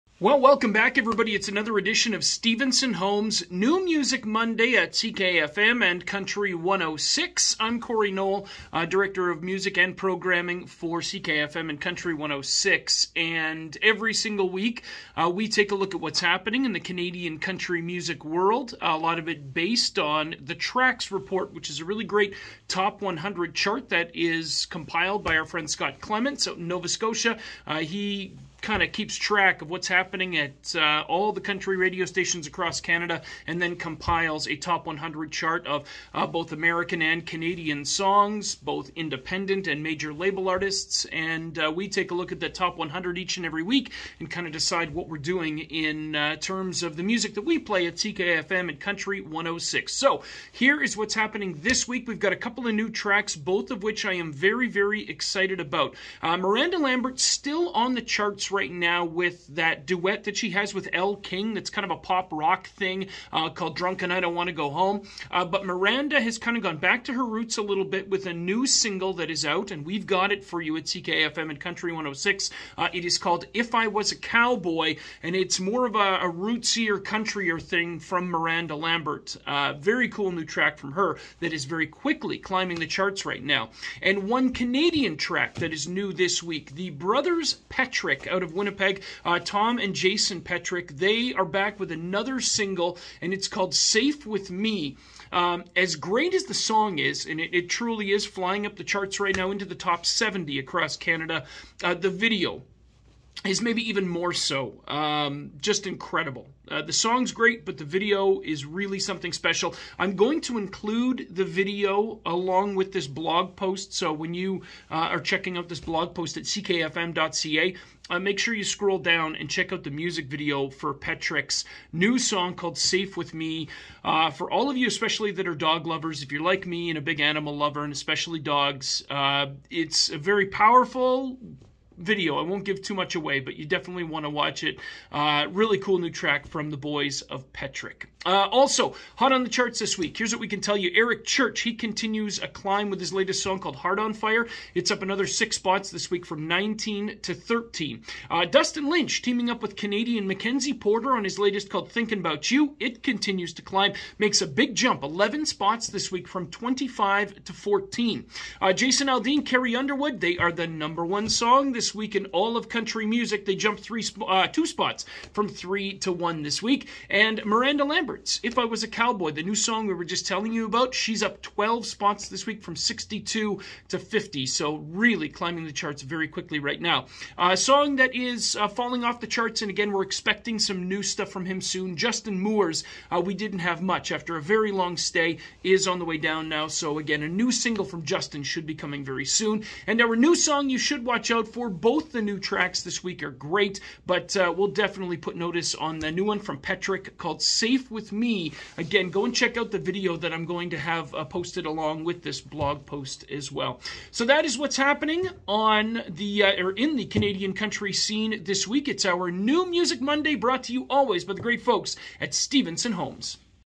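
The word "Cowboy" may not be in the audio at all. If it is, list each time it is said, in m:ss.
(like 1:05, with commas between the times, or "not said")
1:14, 2:48.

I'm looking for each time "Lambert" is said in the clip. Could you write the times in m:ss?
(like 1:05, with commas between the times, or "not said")
0:56, 1:18, 2:47.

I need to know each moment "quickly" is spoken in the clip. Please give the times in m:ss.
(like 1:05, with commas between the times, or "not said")
1:21, 2:56.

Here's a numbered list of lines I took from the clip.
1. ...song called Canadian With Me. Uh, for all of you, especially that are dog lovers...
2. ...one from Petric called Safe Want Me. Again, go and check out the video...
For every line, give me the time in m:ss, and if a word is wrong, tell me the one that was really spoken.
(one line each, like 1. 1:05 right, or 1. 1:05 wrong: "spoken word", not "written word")
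1. 2:02 wrong: "Safe", not "Canadian"
2. 3:16 wrong: "With", not "Want".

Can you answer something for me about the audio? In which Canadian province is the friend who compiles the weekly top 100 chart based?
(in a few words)
Nova Scotia.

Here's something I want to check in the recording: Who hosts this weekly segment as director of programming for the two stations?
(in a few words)
Cory Noel.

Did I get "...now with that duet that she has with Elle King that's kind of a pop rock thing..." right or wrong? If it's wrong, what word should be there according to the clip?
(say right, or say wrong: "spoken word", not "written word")
right.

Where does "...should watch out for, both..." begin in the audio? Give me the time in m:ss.
3:10.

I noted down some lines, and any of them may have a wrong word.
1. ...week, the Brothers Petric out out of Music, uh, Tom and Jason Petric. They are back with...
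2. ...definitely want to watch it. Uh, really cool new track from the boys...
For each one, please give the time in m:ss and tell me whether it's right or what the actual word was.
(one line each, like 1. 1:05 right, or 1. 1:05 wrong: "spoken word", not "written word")
1. 1:26 wrong: "Winnipeg", not "Music"
2. 2:13 right.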